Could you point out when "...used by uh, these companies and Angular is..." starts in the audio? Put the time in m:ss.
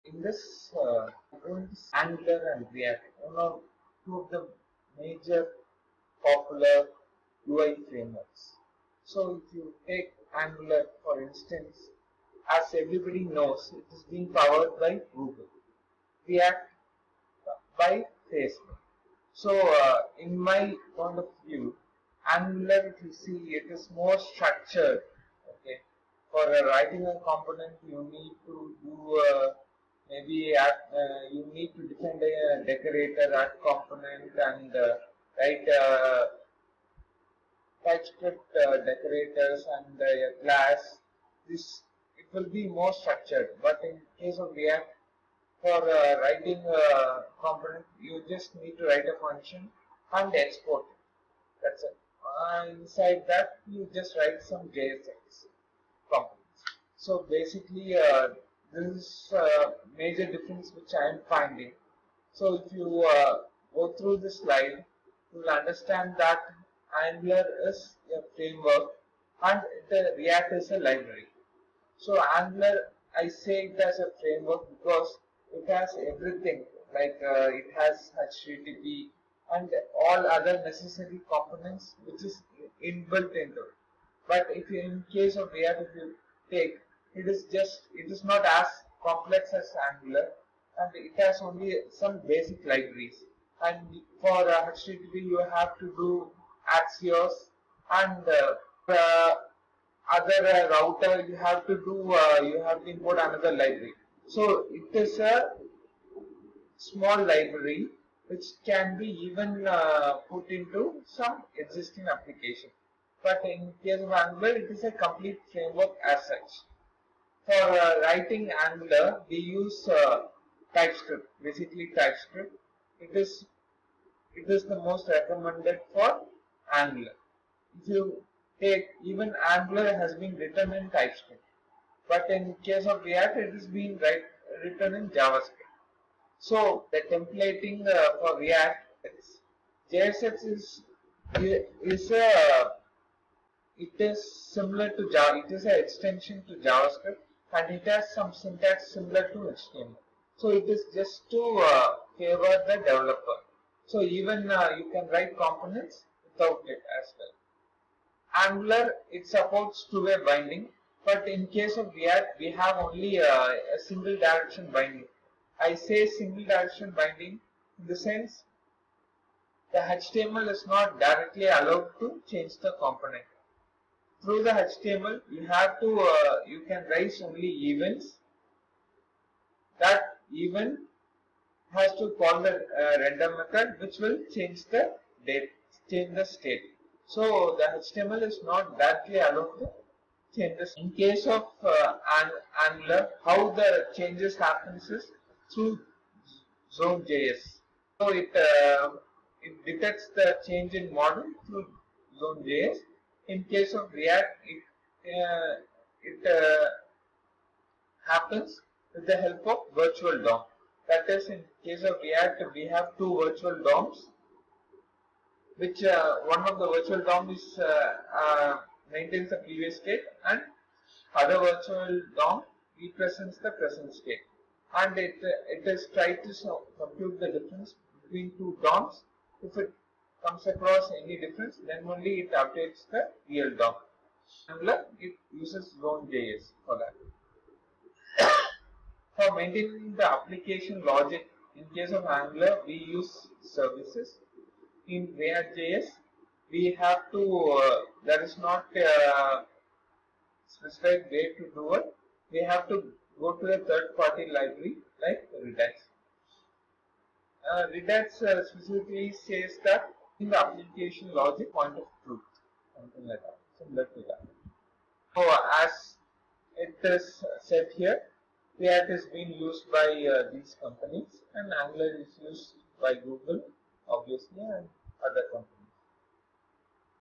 4:29.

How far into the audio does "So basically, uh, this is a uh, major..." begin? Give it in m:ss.
0:56.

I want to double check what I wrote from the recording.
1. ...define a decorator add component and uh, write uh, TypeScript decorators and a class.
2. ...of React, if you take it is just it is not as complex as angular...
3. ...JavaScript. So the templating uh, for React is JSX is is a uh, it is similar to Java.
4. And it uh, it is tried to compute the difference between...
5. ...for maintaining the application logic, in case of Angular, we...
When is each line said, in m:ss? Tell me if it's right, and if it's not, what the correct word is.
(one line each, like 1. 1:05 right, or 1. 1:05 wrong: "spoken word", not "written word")
1. 0:31 right
2. 1:25 right
3. 2:15 right
4. 3:44 right
5. 3:59 right.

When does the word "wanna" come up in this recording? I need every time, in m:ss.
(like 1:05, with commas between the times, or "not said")
not said.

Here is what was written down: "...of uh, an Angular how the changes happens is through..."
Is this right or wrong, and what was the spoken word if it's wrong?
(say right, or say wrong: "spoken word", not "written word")
right.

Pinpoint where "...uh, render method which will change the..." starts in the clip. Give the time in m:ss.
3:02.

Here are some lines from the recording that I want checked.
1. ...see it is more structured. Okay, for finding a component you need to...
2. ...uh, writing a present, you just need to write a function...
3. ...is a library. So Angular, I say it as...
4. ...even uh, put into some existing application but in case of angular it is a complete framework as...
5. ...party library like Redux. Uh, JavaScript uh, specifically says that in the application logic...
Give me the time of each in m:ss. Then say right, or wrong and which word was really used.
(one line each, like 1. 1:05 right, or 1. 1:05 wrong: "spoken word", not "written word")
1. 0:23 wrong: "writing", not "finding"
2. 0:45 wrong: "component", not "present"
3. 1:10 right
4. 1:49 right
5. 4:13 wrong: "Redux", not "JavaScript".